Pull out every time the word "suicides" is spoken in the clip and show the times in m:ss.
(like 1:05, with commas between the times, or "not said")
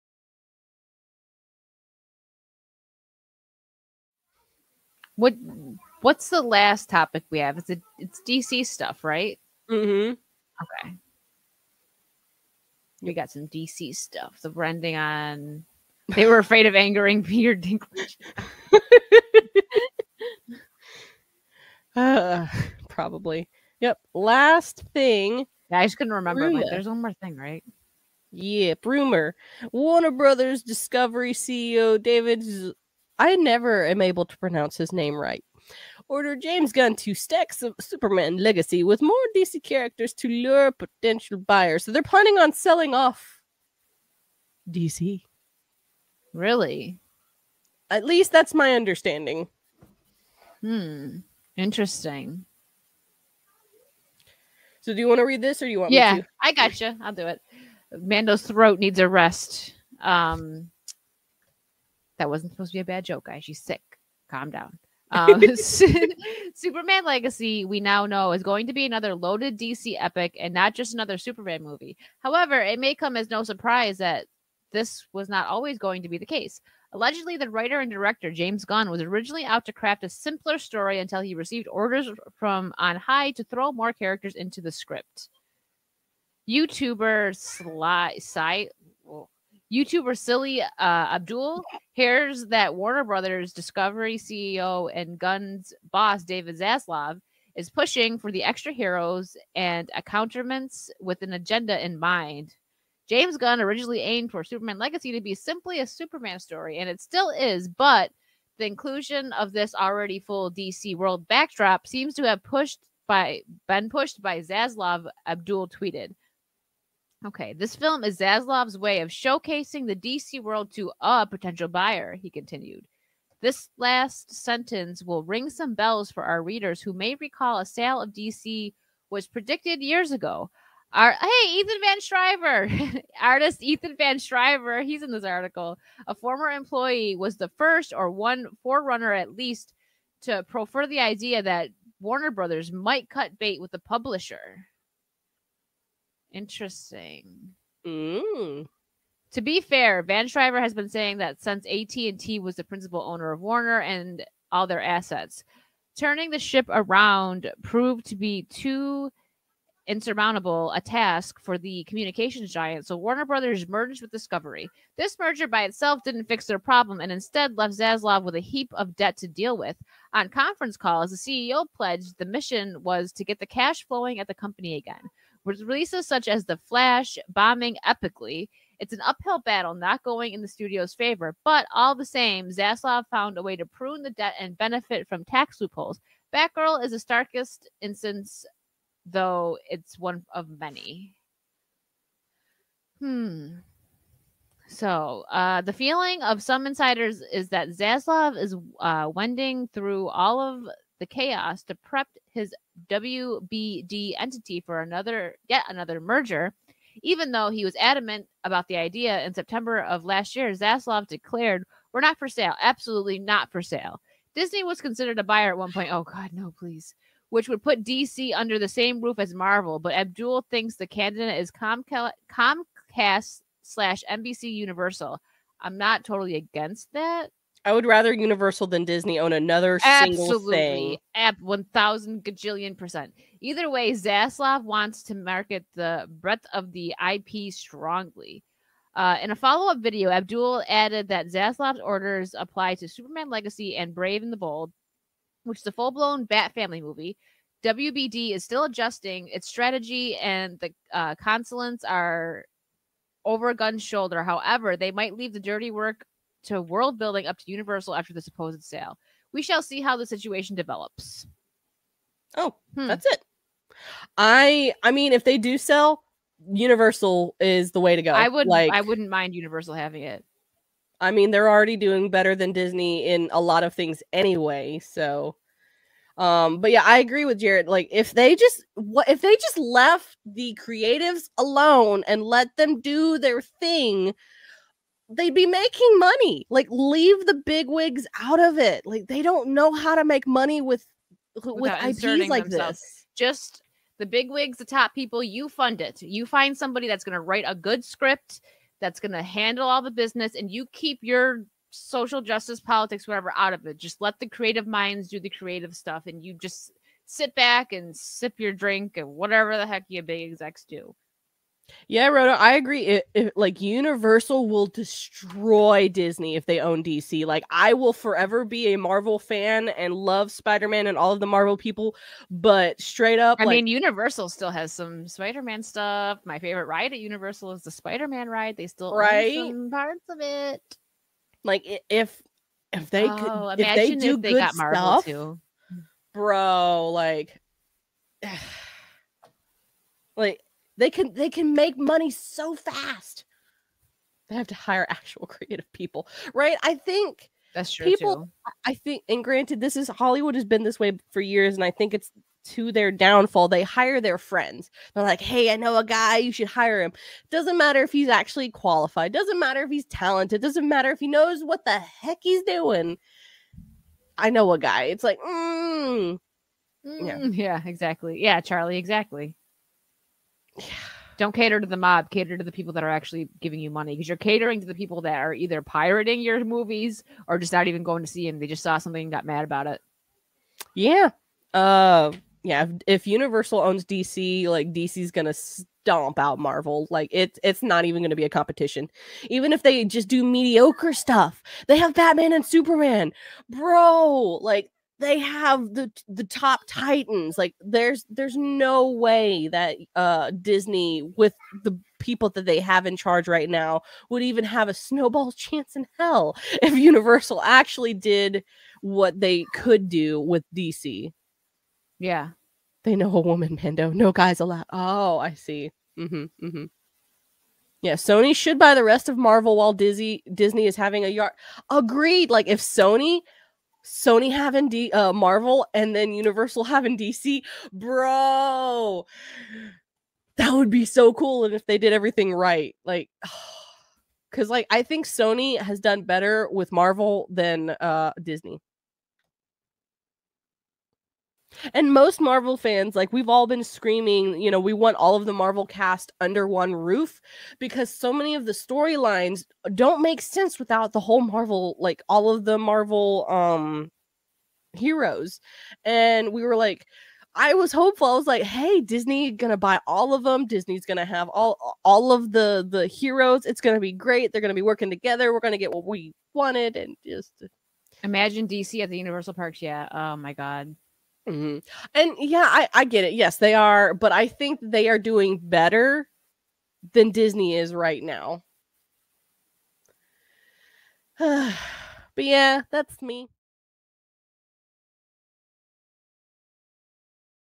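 not said.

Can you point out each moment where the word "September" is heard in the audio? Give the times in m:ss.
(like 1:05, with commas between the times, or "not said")
3:29.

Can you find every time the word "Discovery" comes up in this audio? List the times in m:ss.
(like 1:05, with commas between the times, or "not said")
0:30, 1:33, 2:44.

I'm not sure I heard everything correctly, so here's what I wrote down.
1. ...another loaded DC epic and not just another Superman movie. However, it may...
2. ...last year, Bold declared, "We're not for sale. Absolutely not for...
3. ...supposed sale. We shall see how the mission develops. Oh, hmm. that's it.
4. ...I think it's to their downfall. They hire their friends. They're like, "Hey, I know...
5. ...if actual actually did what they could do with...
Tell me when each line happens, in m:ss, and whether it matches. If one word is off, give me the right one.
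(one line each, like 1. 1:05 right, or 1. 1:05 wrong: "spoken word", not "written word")
1. 1:08 right
2. 3:30 wrong: "Zaslav", not "Bold"
3. 4:18 wrong: "situation", not "mission"
4. 5:51 right
5. 6:46 wrong: "universal", not "actual".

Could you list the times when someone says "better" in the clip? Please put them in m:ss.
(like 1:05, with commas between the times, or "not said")
4:32, 7:16, 7:55.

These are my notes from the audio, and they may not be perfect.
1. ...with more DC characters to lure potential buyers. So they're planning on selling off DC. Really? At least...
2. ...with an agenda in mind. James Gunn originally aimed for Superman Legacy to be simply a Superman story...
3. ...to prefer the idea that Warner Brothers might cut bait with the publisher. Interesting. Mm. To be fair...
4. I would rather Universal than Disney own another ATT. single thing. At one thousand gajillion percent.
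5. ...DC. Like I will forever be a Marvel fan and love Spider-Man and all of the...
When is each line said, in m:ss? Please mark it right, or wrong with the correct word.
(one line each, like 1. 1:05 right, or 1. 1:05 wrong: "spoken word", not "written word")
1. 0:38 right
2. 1:41 right
3. 2:20 right
4. 3:47 wrong: "Absolutely", not "ATT"
5. 5:16 right.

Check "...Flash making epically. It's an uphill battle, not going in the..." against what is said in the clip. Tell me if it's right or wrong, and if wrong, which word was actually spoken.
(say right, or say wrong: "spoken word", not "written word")
wrong: "bombing", not "making".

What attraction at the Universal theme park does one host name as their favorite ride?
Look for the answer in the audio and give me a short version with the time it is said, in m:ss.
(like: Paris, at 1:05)
Spider-Man ride, at 5:27.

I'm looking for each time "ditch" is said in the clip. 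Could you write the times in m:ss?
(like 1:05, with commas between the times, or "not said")
not said.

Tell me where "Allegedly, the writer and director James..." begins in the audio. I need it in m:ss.
1:16.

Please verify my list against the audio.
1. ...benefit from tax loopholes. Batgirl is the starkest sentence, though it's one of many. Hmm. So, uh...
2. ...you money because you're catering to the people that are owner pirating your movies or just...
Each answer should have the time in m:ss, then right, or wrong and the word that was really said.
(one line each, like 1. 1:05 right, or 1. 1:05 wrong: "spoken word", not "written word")
1. 3:04 wrong: "instance", not "sentence"
2. 6:13 wrong: "either", not "owner".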